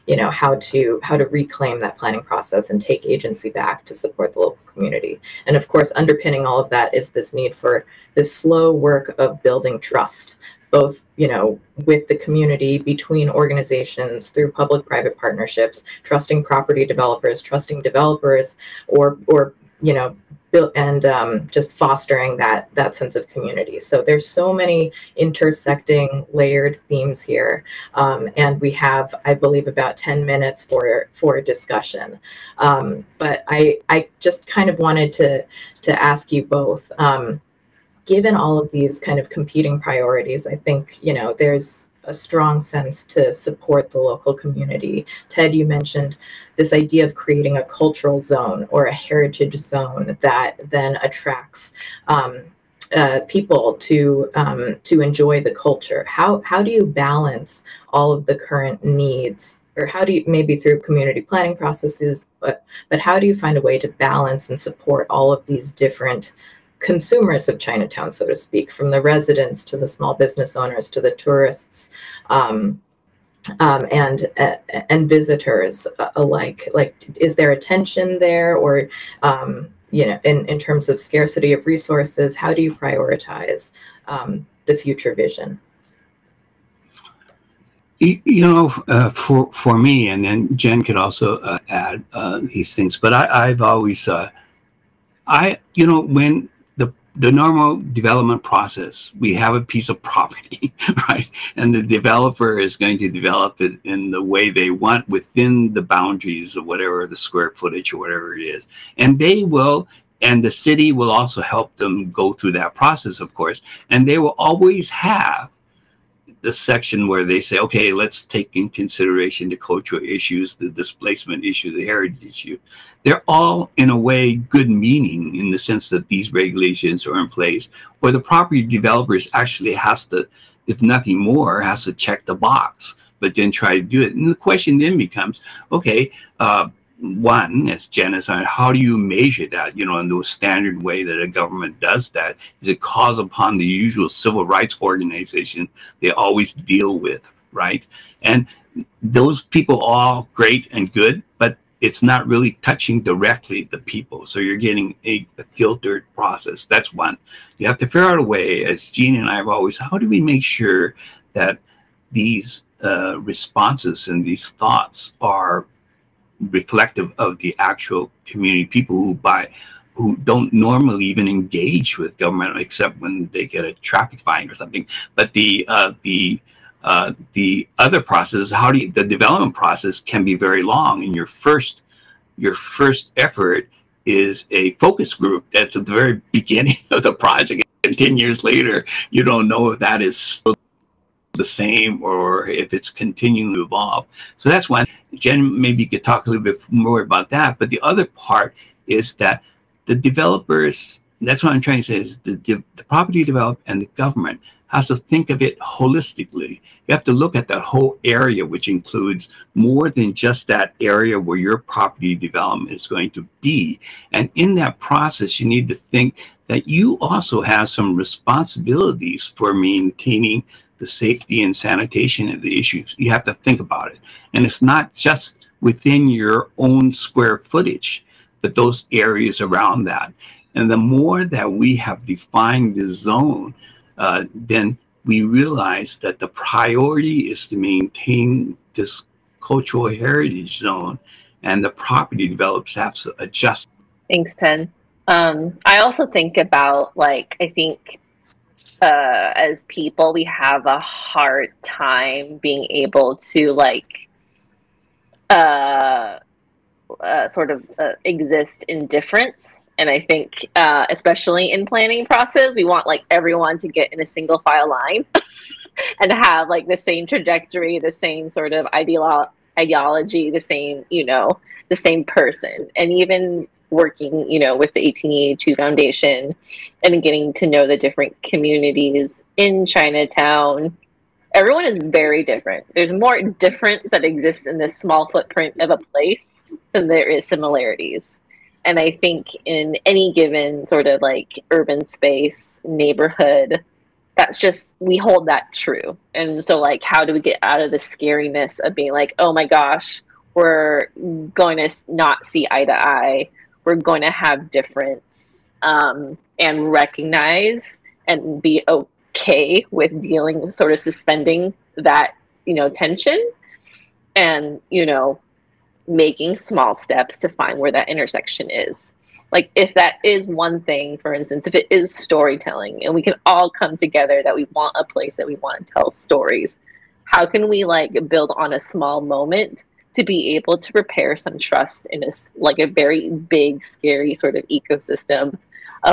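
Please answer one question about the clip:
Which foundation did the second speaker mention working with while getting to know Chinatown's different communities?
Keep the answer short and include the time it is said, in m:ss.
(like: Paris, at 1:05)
1882 Foundation, at 4:34.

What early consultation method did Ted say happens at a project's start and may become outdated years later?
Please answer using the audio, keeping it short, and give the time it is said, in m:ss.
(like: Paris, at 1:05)
focus group, at 3:04.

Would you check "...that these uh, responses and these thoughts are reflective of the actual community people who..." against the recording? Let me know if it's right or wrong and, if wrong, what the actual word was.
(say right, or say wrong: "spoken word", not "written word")
right.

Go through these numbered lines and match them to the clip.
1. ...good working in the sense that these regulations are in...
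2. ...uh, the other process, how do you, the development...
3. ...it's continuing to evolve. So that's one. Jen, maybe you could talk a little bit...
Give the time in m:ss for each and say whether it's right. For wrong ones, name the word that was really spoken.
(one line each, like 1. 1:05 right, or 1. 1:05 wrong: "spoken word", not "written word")
1. 2:04 wrong: "meaning", not "working"
2. 2:56 right
3. 3:12 right.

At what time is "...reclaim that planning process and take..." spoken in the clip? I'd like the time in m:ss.
0:01.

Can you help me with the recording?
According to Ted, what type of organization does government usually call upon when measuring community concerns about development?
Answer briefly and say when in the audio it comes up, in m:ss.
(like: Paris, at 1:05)
civil rights organization, at 2:24.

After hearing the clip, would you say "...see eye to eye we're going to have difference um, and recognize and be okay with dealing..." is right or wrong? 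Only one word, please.
right.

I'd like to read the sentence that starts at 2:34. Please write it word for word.
So you're getting a, a filtered process.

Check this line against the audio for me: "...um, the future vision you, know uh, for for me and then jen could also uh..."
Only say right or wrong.
right.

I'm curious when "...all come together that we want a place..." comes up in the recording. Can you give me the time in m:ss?
5:23.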